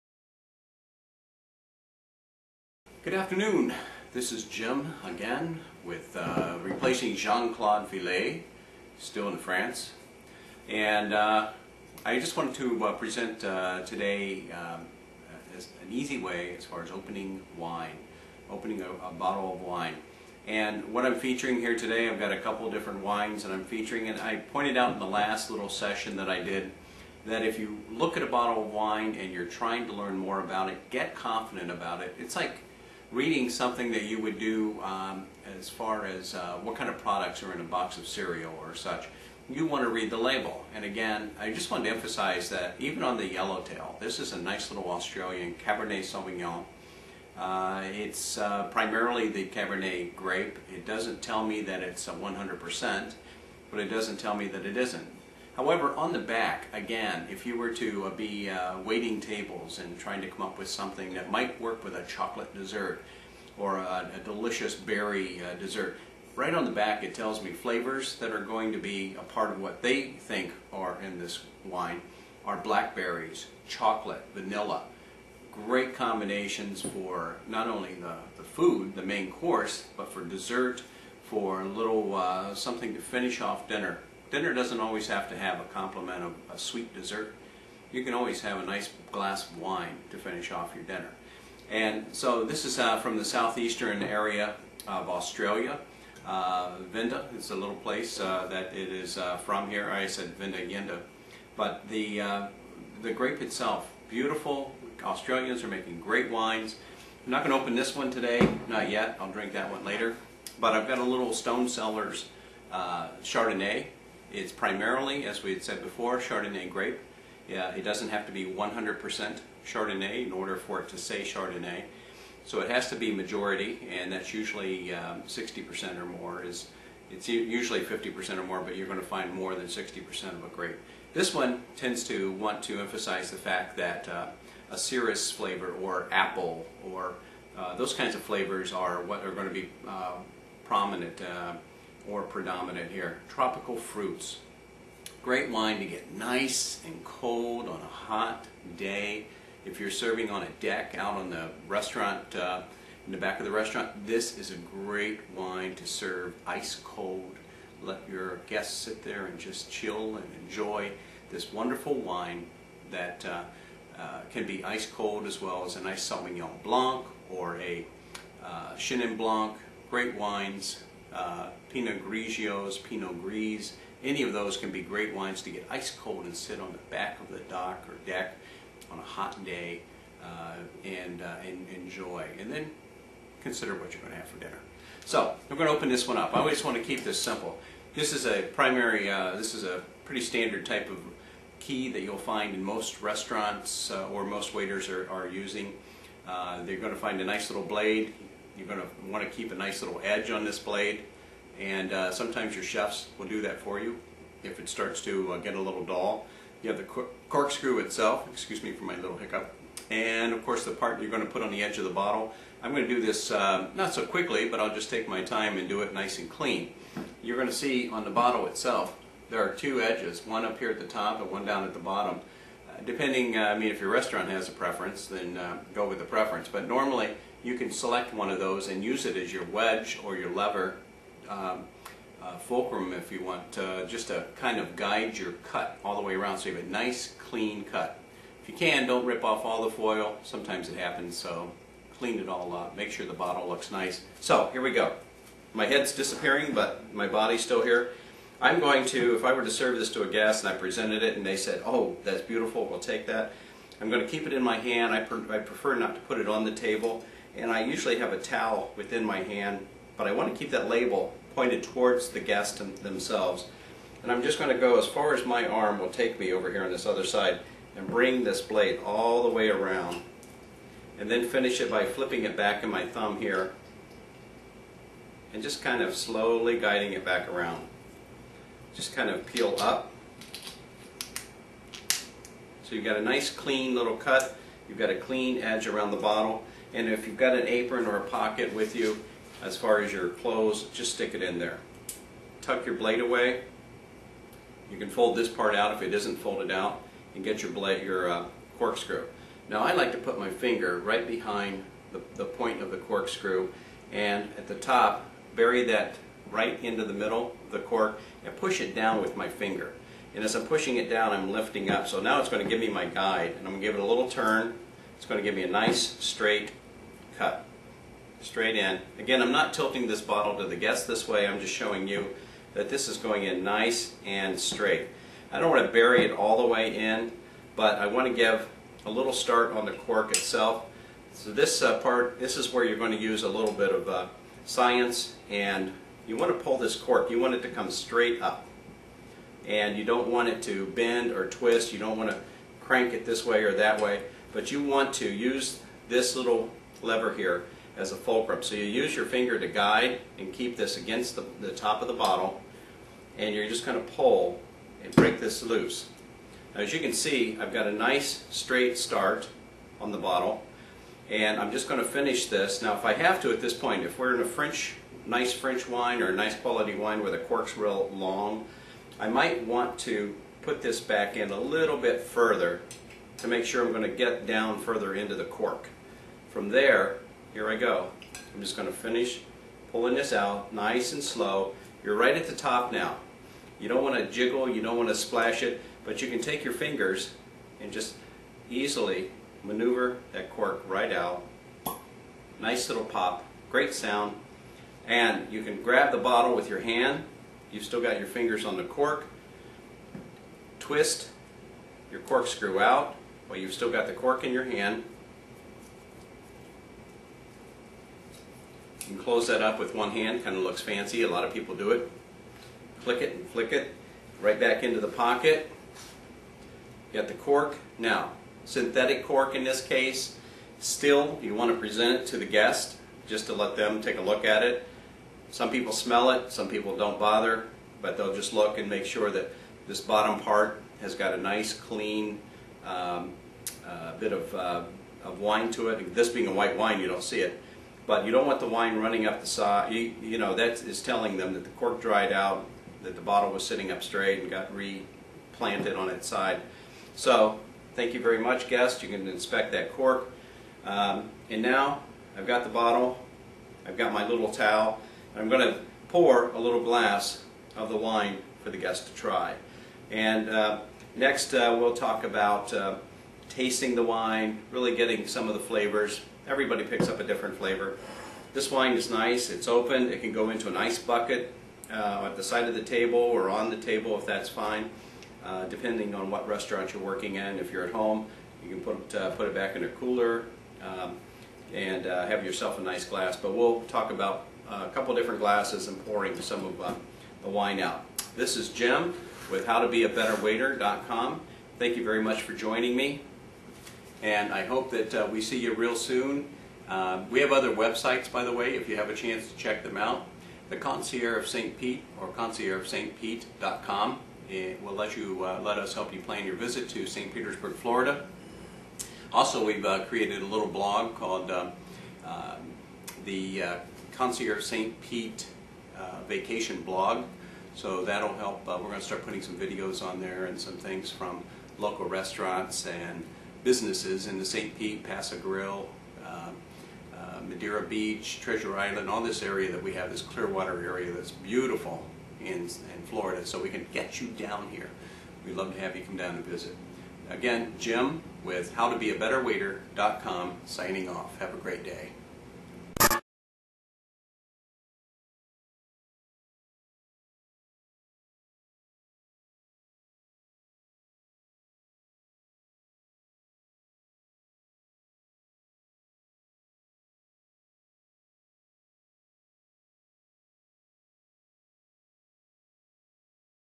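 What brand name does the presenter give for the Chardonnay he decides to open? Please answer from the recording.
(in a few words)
Stone Cellars.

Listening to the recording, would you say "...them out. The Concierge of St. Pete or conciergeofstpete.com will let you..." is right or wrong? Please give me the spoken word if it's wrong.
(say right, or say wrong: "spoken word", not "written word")
right.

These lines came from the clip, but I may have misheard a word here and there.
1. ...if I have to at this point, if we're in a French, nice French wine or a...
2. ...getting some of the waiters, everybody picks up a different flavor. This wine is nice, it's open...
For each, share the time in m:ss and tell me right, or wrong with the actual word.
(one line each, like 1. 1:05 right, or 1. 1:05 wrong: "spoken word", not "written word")
1. 6:02 right
2. 7:44 wrong: "flavors", not "waiters".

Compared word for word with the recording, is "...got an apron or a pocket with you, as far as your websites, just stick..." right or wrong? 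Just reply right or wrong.
wrong.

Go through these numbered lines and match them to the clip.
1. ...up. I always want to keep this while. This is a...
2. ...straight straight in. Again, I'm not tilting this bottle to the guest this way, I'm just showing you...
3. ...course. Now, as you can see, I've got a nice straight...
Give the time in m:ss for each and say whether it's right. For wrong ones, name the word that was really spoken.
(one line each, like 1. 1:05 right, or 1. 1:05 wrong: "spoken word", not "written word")
1. 3:06 wrong: "simple", not "while"
2. 5:16 right
3. 5:55 wrong: "loose", not "course".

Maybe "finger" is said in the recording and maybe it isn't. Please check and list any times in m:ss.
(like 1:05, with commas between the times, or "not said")
5:00, 5:09, 5:49, 6:26, 6:38.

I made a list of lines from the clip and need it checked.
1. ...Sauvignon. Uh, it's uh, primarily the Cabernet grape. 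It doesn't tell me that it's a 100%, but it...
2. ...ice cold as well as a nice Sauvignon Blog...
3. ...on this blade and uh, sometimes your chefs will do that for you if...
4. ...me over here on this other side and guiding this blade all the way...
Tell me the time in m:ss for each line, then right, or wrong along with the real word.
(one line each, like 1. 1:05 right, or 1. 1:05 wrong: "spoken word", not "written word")
1. 0:46 right
2. 2:44 wrong: "Blanc", not "Blog"
3. 3:20 right
4. 4:26 wrong: "bring", not "guiding".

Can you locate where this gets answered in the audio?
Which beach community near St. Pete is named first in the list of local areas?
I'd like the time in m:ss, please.
8:44.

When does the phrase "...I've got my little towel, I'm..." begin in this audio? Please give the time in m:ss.
7:33.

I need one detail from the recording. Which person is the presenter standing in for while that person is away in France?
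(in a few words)
Jean-Claude Villet.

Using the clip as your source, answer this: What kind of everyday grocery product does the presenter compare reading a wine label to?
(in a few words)
Box of cereal.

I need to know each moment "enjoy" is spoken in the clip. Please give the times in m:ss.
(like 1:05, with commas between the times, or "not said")
2:40, 3:01.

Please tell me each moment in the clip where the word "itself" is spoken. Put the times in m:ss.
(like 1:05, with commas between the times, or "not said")
1:43, 3:27, 3:38, 5:30.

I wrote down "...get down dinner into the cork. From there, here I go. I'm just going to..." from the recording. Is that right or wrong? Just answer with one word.
wrong.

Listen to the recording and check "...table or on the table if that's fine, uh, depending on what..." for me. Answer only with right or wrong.
right.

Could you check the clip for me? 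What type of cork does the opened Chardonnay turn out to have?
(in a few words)
Synthetic cork.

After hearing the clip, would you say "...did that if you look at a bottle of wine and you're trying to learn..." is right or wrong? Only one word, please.
right.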